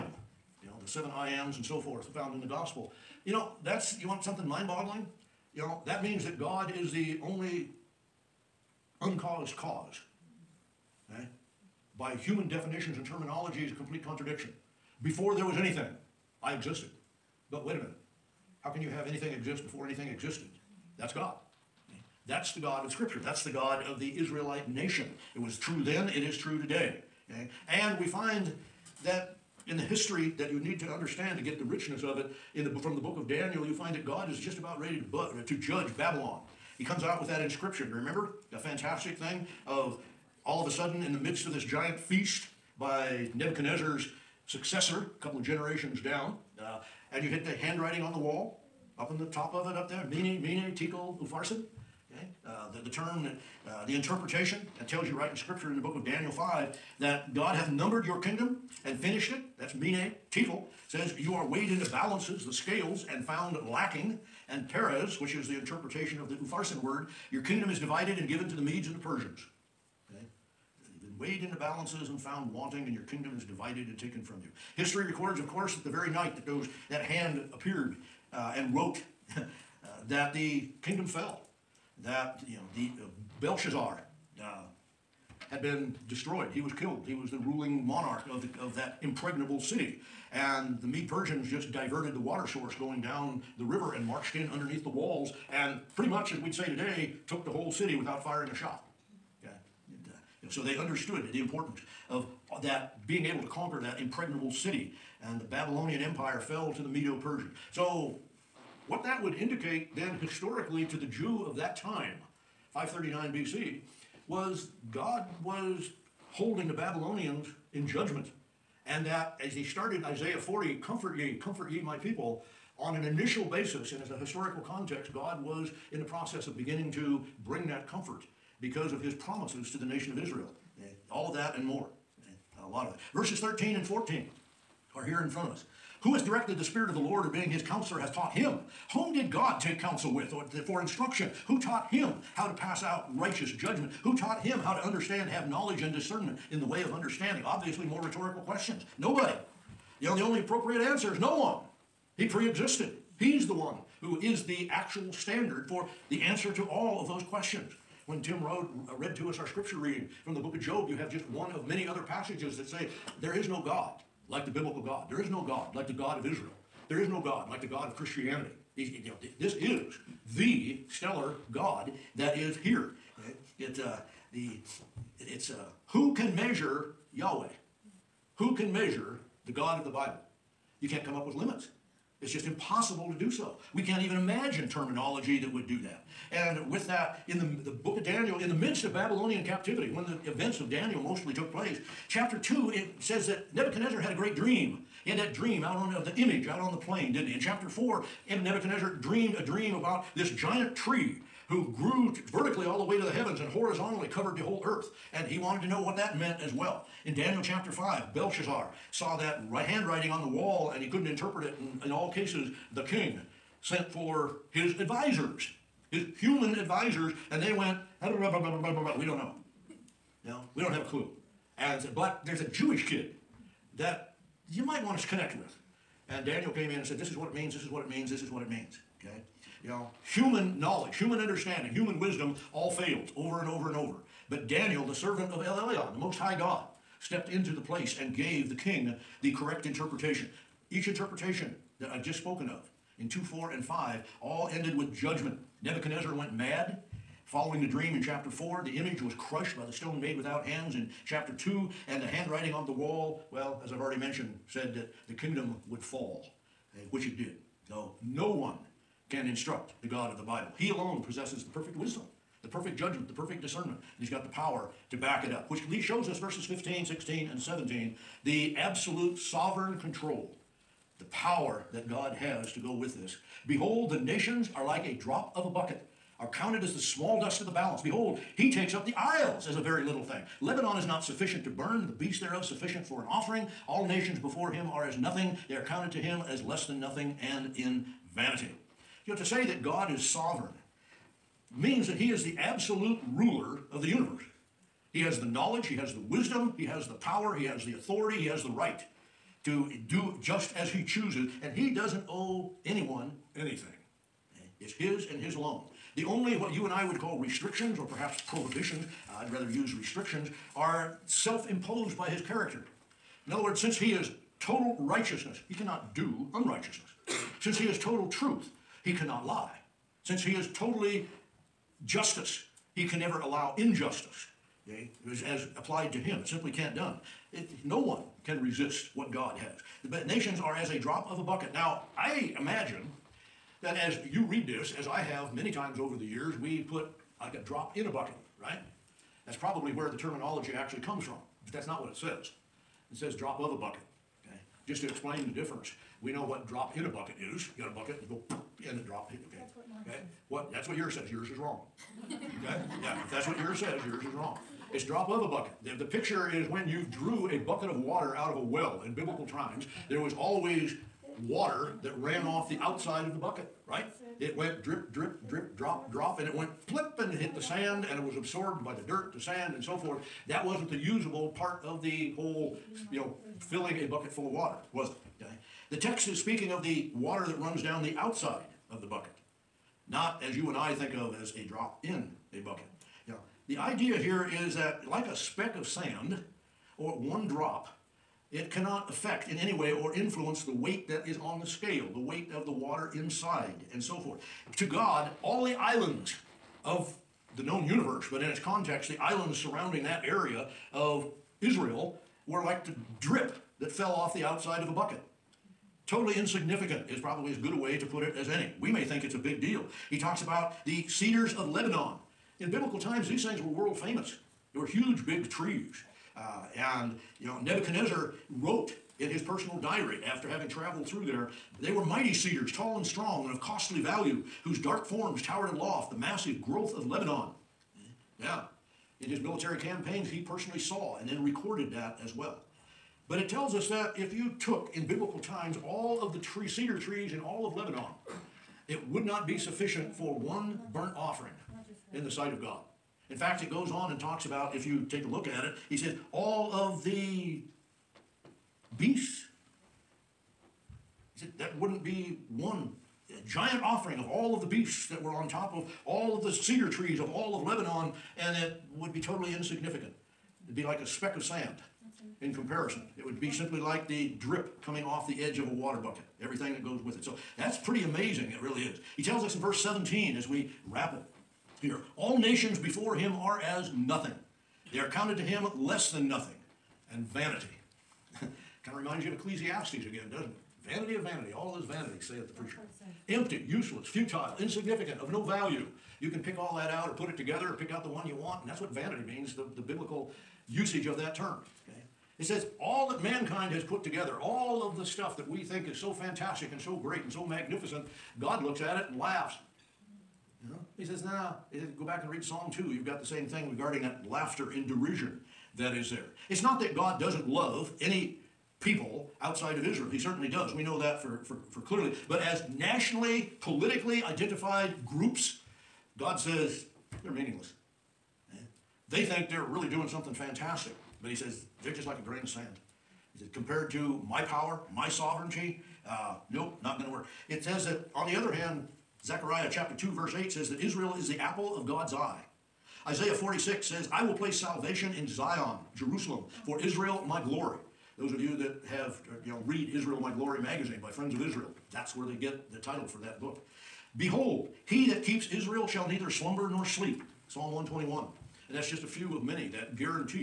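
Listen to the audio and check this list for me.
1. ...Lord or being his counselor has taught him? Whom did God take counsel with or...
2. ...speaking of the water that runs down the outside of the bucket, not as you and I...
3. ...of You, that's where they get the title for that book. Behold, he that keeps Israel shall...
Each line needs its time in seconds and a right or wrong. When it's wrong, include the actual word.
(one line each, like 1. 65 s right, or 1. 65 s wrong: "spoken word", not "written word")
1. 136 s right
2. 376 s right
3. 541 s wrong: "Israel", not "You".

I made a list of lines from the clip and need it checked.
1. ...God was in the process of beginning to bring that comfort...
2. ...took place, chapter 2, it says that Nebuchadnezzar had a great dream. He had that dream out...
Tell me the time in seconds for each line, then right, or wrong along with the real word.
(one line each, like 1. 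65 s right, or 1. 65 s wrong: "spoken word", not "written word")
1. 125 s right
2. 191 s right.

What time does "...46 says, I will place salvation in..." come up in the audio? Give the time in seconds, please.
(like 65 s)
533 s.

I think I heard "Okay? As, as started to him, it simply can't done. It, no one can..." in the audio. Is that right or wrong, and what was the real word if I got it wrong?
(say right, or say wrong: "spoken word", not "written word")
wrong: "applied", not "started".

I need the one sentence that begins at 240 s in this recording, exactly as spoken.
Each interpretation that I've just spoken of in 2, 4, and 5 all ended with judgment.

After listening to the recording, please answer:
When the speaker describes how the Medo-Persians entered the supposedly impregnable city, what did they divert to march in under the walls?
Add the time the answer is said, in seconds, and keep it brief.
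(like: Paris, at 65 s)
The water source, at 92 s.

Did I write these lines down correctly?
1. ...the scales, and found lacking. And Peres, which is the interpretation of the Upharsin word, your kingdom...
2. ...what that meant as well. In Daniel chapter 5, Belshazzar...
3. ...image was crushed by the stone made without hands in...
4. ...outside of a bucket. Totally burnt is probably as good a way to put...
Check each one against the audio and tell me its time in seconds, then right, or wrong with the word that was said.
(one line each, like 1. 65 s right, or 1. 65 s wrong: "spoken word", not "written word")
1. 62 s right
2. 205 s right
3. 248 s right
4. 404 s wrong: "insignificant", not "burnt".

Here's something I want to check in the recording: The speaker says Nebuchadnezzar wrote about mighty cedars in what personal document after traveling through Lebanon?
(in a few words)
His personal diary.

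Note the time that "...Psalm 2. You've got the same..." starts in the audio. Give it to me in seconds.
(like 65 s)
502 s.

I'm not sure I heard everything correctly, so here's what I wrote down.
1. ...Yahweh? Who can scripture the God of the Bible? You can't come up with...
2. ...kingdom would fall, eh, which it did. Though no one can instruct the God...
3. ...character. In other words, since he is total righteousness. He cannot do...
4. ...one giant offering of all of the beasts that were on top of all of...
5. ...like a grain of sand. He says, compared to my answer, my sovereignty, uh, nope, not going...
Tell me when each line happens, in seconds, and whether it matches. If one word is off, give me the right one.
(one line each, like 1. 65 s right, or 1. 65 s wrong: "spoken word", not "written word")
1. 177 s wrong: "measure", not "scripture"
2. 255 s right
3. 312 s right
4. 452 s right
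5. 521 s wrong: "power", not "answer".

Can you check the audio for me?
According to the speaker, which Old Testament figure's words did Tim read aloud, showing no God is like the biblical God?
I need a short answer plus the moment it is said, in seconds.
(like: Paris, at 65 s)
Job, at 160 s.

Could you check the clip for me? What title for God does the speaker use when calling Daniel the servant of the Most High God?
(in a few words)
El Elyon.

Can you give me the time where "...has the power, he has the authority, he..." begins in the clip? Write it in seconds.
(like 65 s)
296 s.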